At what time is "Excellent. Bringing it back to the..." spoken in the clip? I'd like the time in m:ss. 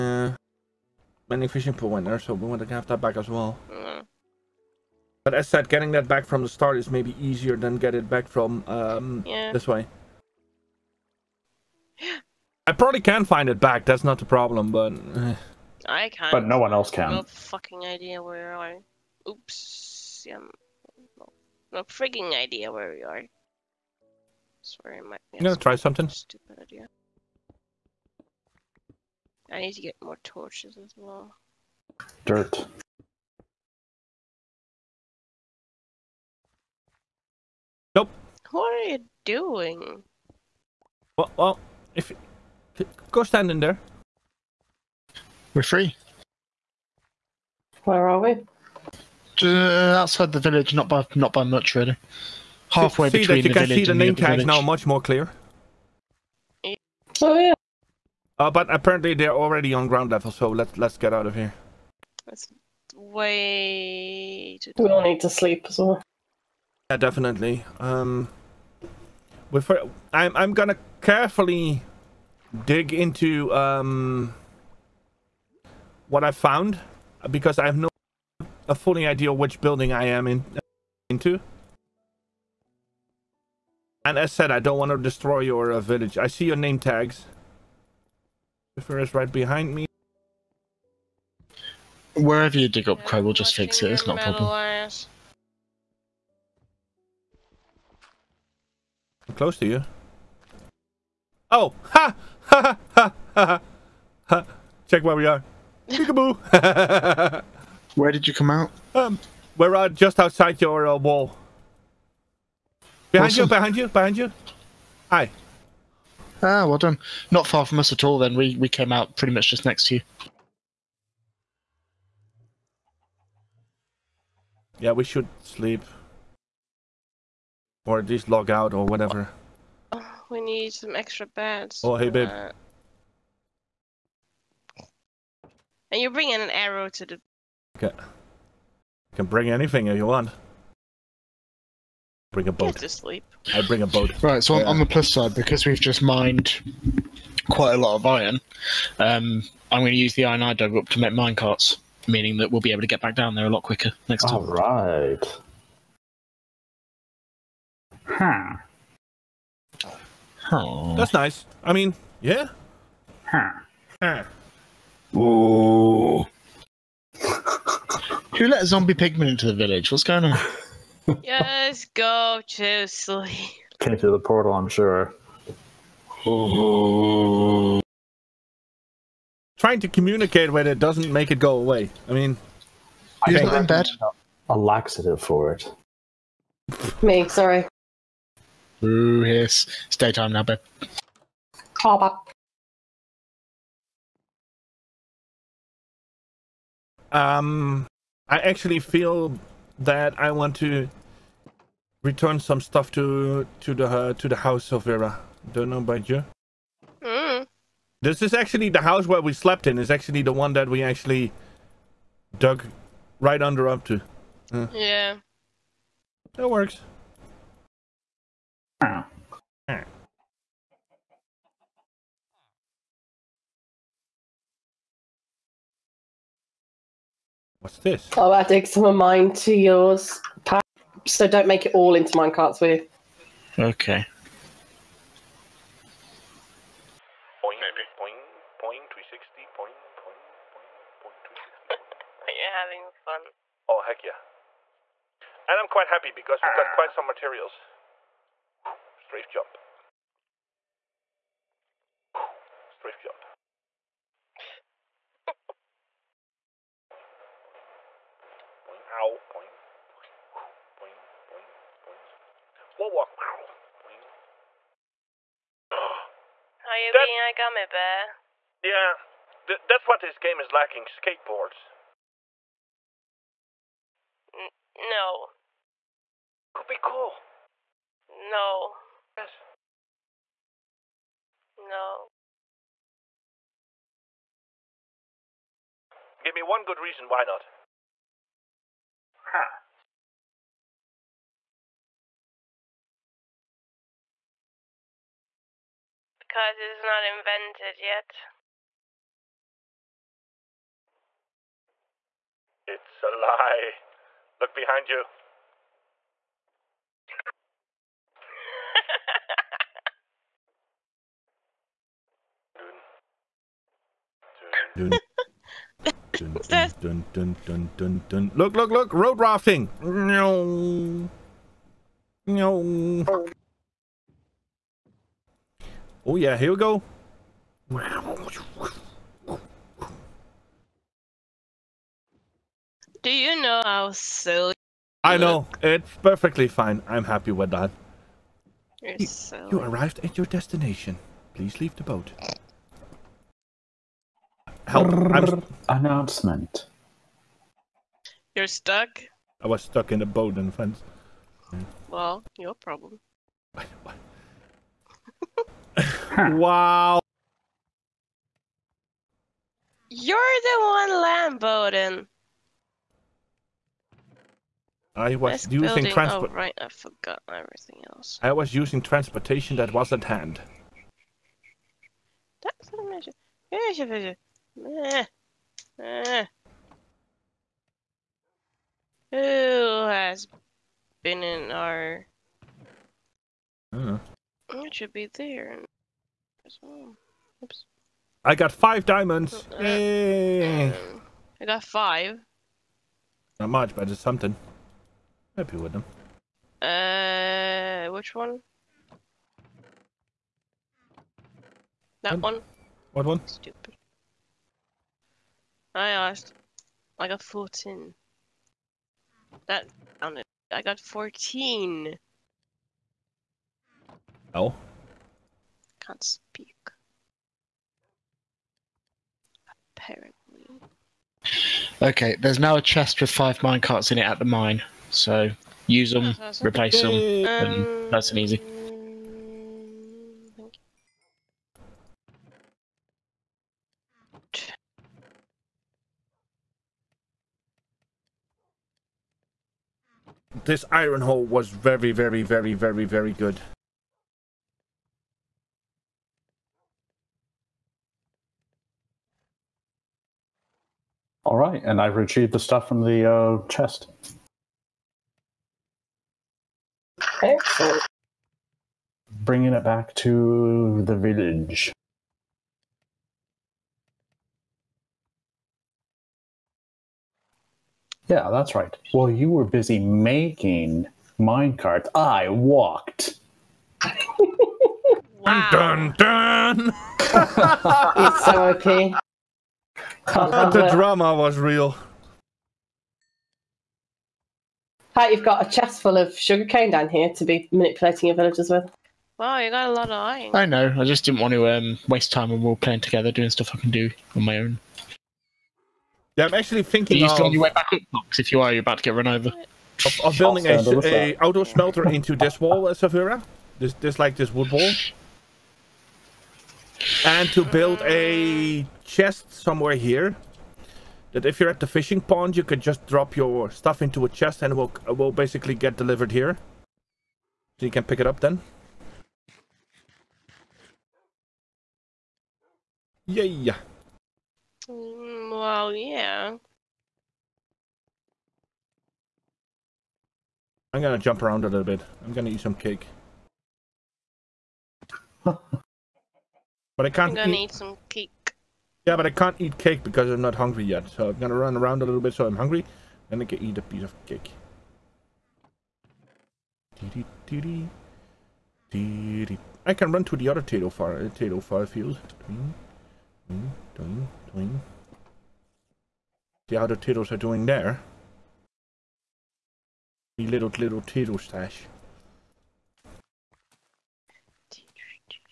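7:37.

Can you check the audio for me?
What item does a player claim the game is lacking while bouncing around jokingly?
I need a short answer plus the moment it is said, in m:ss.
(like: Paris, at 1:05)
Skateboards, at 4:30.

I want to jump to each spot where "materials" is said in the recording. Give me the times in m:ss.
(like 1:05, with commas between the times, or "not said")
4:07.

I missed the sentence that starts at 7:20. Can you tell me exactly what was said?
this iron hole was very, very, very, very, very good.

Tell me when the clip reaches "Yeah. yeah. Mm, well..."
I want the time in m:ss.
8:43.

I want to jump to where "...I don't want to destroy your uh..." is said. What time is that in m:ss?
1:24.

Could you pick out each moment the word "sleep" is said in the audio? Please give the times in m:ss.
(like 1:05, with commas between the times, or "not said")
1:05, 2:05, 2:22, 2:52.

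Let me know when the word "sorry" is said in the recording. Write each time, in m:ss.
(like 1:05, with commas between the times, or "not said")
0:24, 3:07.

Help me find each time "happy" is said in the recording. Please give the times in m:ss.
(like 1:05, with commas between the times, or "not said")
4:05, 5:37, 6:35.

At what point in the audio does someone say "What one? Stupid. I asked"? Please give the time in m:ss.
6:42.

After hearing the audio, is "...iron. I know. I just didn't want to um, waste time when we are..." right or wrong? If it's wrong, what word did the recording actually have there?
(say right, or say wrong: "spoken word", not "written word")
right.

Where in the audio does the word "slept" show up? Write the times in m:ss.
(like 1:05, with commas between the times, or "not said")
3:29.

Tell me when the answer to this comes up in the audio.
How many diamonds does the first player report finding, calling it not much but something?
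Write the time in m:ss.
6:28.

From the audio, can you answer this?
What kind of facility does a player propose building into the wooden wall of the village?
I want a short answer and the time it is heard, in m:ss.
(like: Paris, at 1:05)
Outdoor smelter, at 8:21.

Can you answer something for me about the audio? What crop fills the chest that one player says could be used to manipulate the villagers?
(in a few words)
Sugarcane.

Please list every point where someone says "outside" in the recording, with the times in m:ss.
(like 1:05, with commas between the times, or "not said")
0:50, 1:50.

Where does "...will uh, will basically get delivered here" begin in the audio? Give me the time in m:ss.
8:34.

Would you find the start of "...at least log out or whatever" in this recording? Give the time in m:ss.
2:07.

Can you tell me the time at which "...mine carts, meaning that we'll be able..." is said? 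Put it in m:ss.
2:31.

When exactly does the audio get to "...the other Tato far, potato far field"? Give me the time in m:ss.
9:10.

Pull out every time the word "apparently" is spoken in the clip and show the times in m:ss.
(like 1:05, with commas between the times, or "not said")
0:58, 6:59.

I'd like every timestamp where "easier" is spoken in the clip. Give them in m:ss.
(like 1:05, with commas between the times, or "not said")
0:07.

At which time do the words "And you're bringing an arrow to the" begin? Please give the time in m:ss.
2:15.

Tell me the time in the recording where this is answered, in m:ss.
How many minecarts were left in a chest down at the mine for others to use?
7:03.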